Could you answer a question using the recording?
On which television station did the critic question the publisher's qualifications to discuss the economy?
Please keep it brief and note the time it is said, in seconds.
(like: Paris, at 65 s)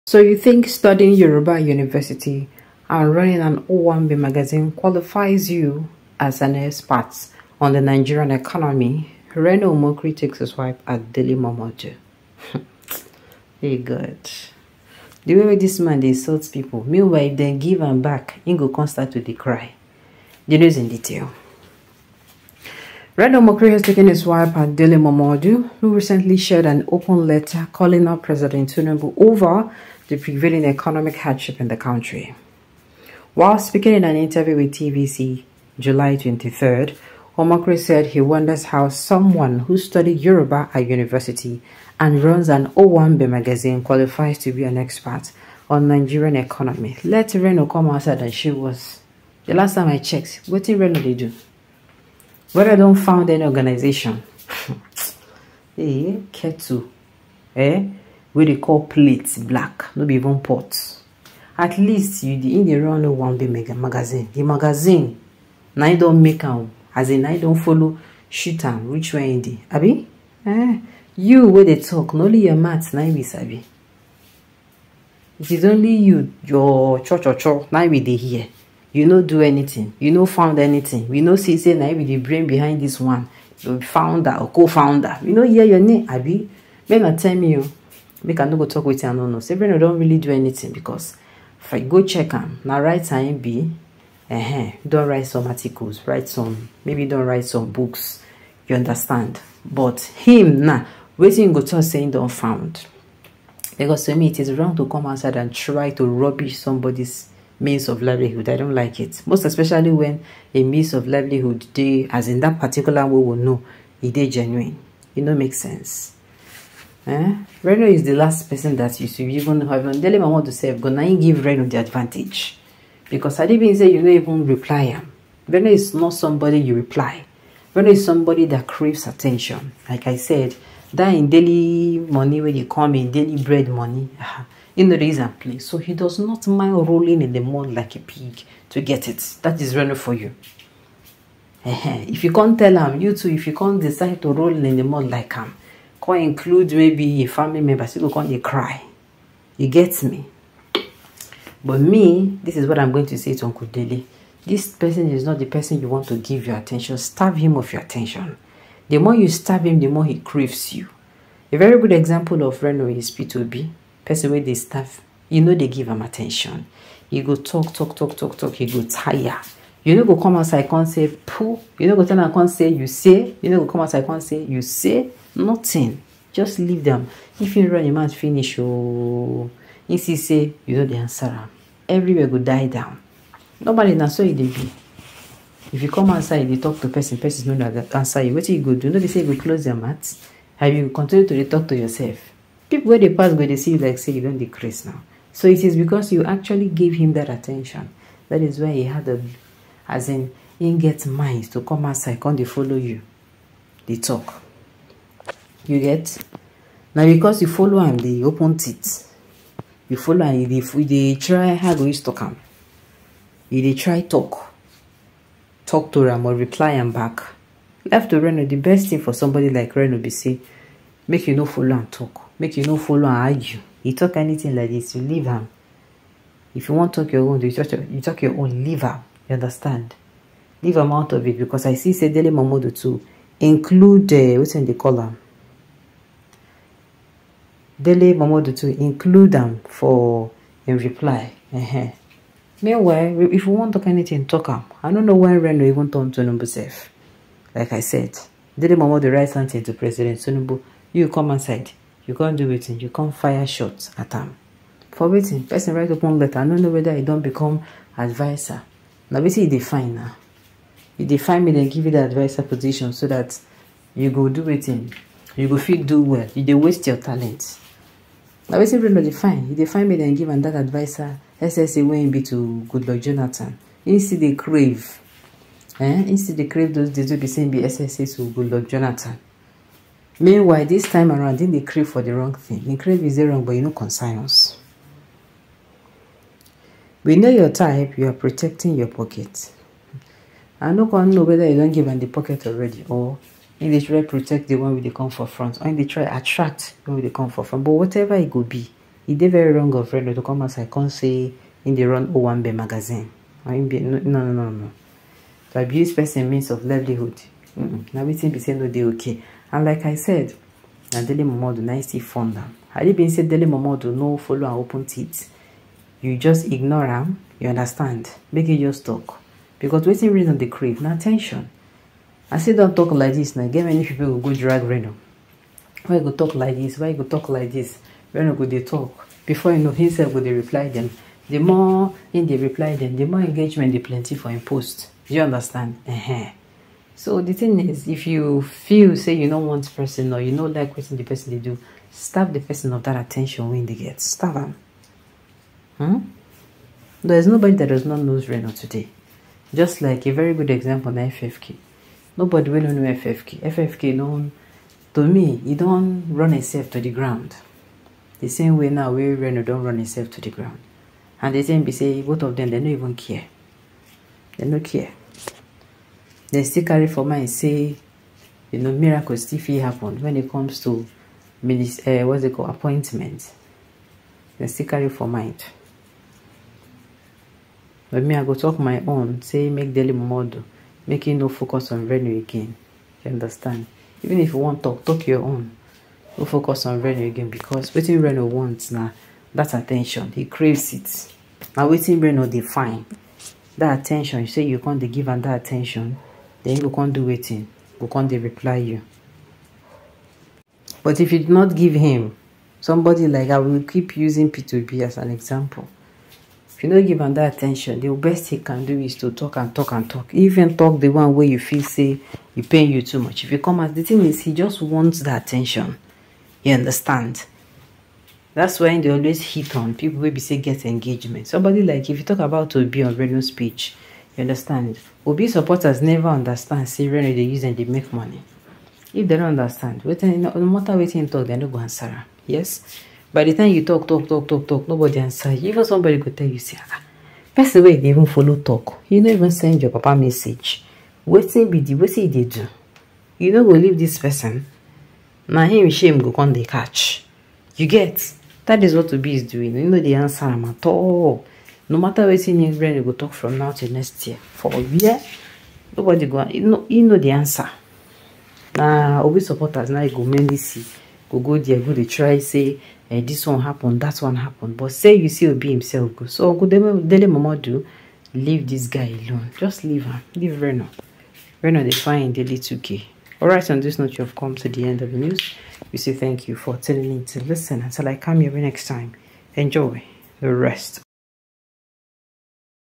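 TVC, at 34 s.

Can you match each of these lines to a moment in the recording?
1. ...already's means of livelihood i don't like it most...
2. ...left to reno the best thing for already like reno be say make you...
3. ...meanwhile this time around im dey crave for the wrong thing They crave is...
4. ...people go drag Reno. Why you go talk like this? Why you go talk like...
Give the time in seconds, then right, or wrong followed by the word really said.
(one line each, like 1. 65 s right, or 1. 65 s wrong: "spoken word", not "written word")
1. 106 s wrong: "somebody", not "already"
2. 217 s wrong: "somebody", not "already"
3. 280 s right
4. 323 s right.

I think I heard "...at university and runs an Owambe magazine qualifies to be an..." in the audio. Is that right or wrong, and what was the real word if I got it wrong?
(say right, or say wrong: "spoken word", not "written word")
right.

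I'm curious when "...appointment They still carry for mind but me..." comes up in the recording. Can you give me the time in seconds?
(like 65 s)
372 s.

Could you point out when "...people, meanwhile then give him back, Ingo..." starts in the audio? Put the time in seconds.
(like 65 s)
16 s.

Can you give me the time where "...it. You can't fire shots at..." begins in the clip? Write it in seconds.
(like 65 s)
252 s.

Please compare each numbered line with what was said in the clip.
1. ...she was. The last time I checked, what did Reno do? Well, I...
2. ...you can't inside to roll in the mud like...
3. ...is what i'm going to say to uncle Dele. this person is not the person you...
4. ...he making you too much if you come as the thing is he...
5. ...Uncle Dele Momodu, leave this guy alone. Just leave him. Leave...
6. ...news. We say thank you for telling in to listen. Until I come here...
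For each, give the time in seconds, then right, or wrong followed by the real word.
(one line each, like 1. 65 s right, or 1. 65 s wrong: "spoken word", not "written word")
1. 48 s right
2. 143 s wrong: "decide", not "inside"
3. 152 s right
4. 412 s wrong: "paying", not "making"
5. 466 s right
6. 474 s right.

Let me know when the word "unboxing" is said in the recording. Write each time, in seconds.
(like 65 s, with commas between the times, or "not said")
not said.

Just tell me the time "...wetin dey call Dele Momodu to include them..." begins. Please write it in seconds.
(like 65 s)
234 s.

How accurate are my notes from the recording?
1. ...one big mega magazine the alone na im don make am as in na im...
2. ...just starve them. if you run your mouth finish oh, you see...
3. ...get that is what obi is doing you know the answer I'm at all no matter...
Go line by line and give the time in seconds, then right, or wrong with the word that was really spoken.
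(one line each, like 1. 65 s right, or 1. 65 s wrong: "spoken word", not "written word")
1. 63 s wrong: "magazine", not "alone"
2. 176 s wrong: "leave", not "starve"
3. 447 s right.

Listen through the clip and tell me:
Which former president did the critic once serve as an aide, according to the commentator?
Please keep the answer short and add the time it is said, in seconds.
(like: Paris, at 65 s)
Goodluck Jonathan, at 272 s.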